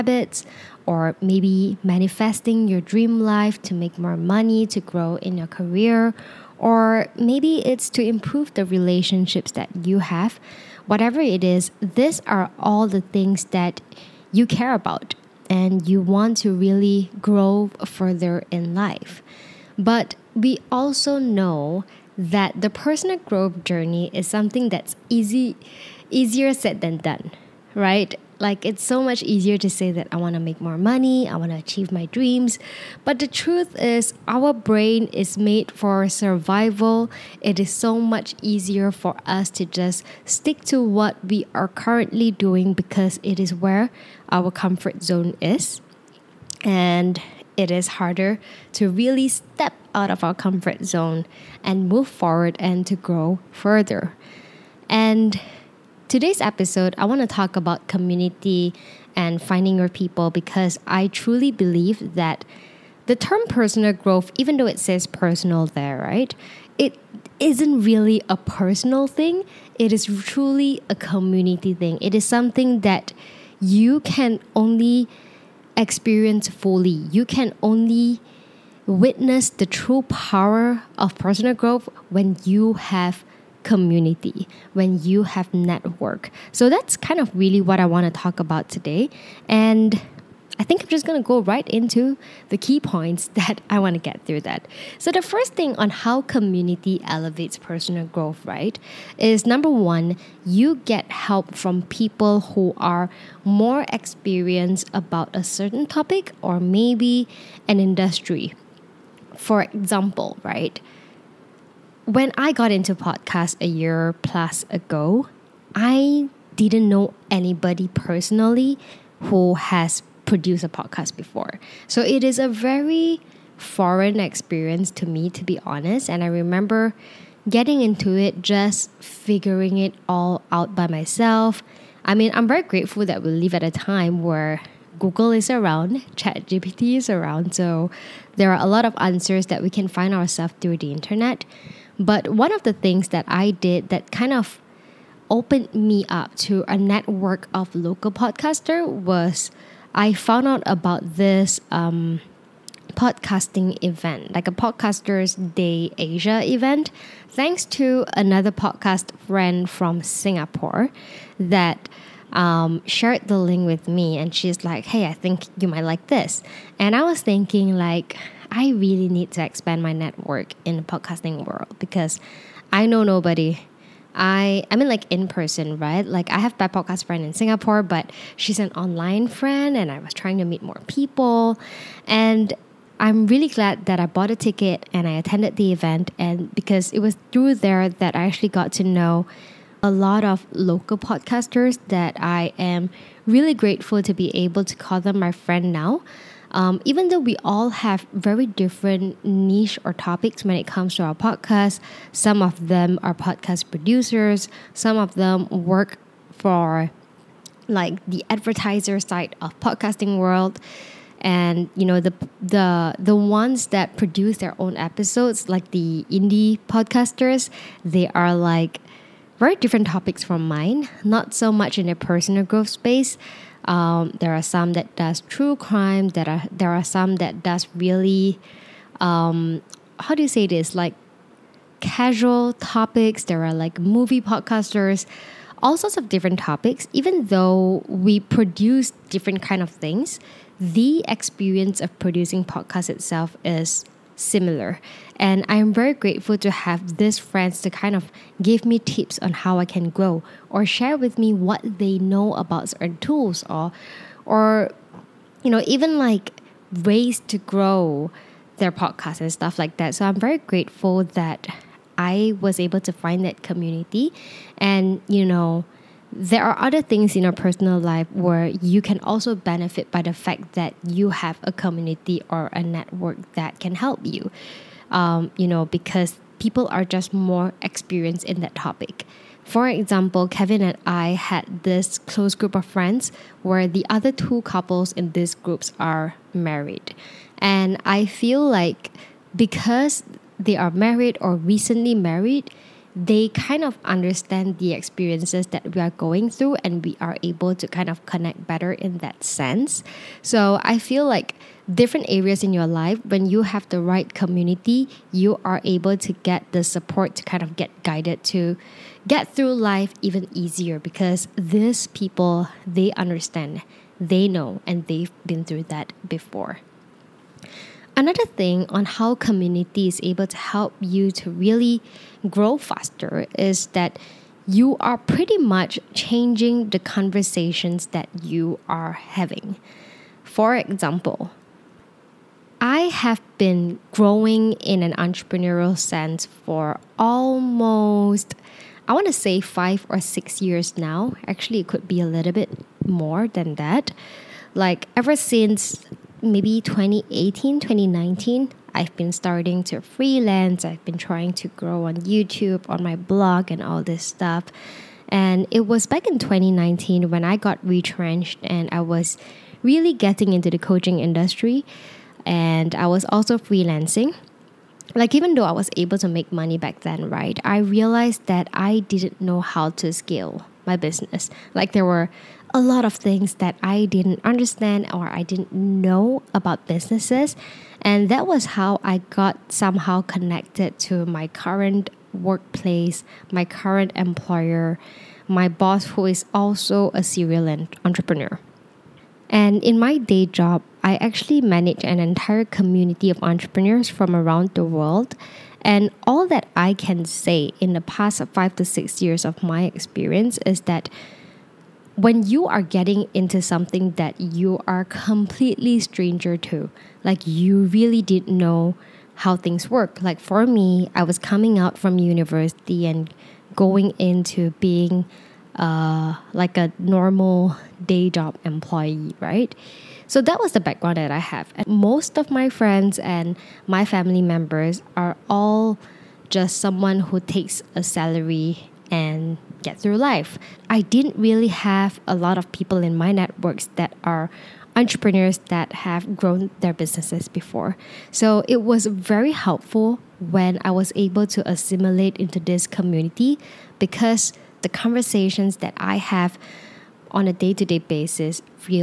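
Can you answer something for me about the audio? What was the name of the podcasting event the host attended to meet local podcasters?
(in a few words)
Podcasters Day Asia.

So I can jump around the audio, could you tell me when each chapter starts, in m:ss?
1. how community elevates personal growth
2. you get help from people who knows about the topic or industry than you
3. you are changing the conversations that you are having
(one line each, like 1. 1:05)
1. 0:54
2. 1:34
3. 5:17.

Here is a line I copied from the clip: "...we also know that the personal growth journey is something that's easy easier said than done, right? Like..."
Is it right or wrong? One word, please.
right.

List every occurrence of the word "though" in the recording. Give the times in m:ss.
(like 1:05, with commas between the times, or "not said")
1:04, 3:17, 3:57, 6:05.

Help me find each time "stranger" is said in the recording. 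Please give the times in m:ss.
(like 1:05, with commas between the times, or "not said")
6:45.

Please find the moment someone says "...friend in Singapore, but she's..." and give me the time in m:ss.
2:57.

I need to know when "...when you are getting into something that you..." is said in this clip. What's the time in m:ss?
6:41.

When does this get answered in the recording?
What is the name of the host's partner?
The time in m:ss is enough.
4:40.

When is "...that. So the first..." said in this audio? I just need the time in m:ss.
1:34.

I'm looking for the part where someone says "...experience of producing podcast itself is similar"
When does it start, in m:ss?
4:01.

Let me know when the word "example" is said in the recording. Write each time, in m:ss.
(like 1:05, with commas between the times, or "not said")
1:49, 4:39, 5:30.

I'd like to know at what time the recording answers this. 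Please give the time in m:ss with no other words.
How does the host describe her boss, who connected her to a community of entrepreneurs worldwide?
6:27.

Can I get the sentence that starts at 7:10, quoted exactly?
I didn't really have a lot of people in my networks that are entrepreneurs that have grown their businesses before.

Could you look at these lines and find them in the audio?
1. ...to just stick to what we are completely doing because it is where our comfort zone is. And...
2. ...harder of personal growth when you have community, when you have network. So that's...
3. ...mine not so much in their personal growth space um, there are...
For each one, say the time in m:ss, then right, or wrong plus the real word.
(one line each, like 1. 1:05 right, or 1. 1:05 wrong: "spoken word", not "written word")
1. 0:39 wrong: "currently", not "completely"
2. 1:20 wrong: "power", not "harder"
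3. 3:40 right.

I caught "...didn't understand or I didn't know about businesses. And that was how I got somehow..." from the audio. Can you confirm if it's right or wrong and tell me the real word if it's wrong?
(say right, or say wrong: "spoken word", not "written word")
right.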